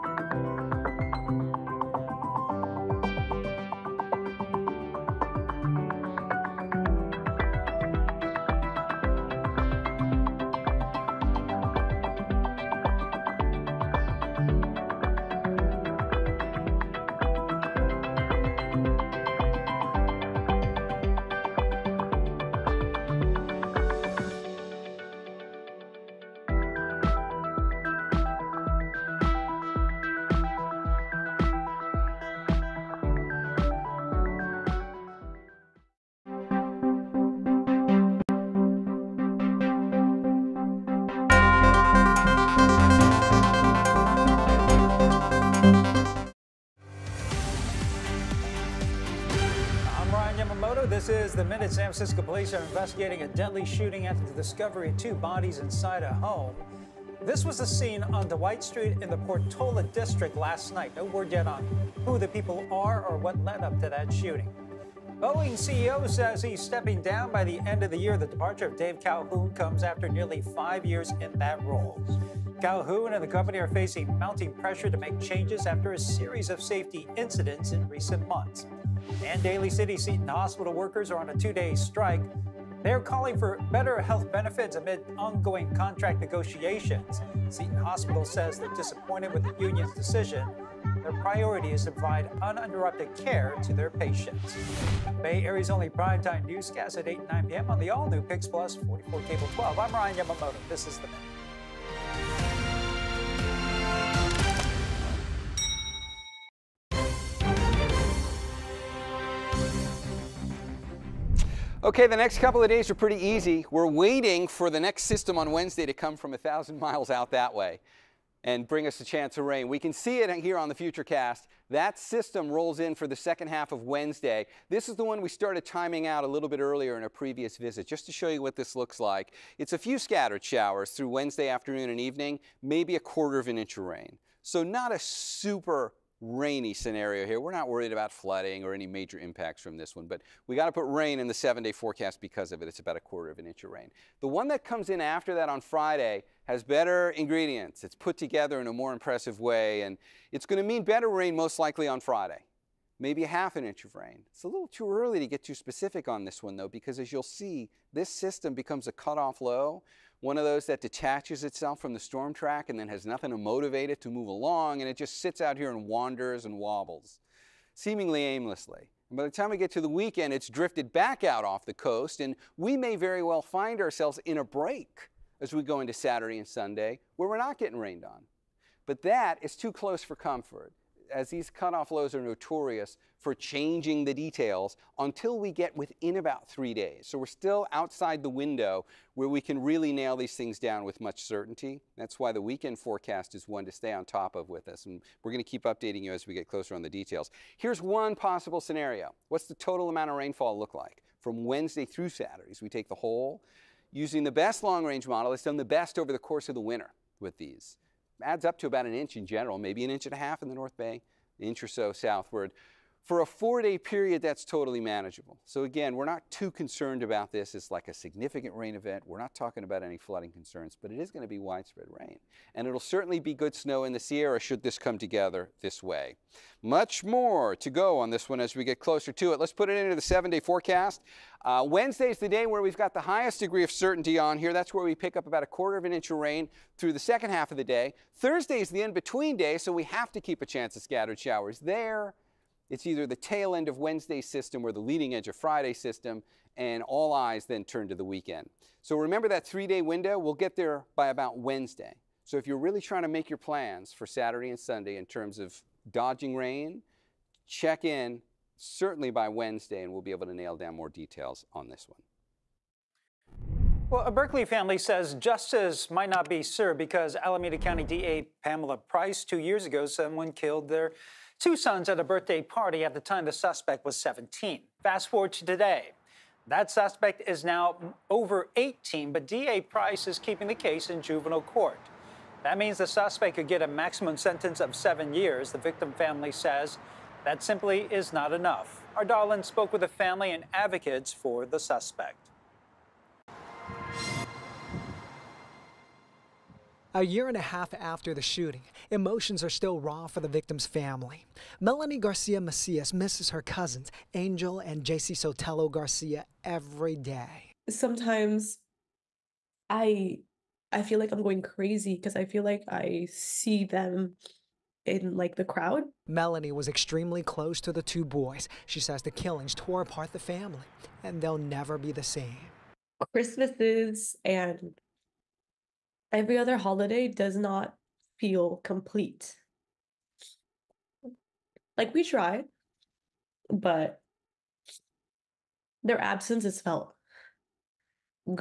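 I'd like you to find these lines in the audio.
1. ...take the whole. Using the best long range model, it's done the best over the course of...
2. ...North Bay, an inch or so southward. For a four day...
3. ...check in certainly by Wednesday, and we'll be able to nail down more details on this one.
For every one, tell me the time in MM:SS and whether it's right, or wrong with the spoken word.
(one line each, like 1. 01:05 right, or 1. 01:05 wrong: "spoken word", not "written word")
1. 03:22 right
2. 03:30 right
3. 04:17 right.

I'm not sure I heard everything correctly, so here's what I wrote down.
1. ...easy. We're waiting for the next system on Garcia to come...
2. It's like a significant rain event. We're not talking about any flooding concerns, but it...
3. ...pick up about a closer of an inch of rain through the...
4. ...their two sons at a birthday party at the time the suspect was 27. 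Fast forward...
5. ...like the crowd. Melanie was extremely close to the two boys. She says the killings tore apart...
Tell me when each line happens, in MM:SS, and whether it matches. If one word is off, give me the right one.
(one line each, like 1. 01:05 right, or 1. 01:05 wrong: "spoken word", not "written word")
1. 01:53 wrong: "Wednesday", not "Garcia"
2. 03:37 right
3. 03:54 wrong: "quarter", not "closer"
4. 04:30 wrong: "17", not "27"
5. 05:15 right.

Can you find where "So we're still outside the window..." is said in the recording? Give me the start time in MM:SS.
03:07.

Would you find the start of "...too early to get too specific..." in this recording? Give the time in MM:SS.
02:34.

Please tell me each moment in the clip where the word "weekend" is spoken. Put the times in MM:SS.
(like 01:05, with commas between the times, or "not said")
02:49, 03:12, 04:08.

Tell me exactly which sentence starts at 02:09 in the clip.
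It's a few scattered showers through Wednesday afternoon and evening, maybe a quarter of an inch of rain.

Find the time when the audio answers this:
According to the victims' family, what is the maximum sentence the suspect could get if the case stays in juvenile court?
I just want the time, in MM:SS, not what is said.
04:44.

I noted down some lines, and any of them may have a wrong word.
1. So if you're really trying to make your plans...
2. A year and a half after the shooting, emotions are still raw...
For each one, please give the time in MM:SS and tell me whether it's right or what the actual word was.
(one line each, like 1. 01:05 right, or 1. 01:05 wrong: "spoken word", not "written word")
1. 04:12 right
2. 04:56 right.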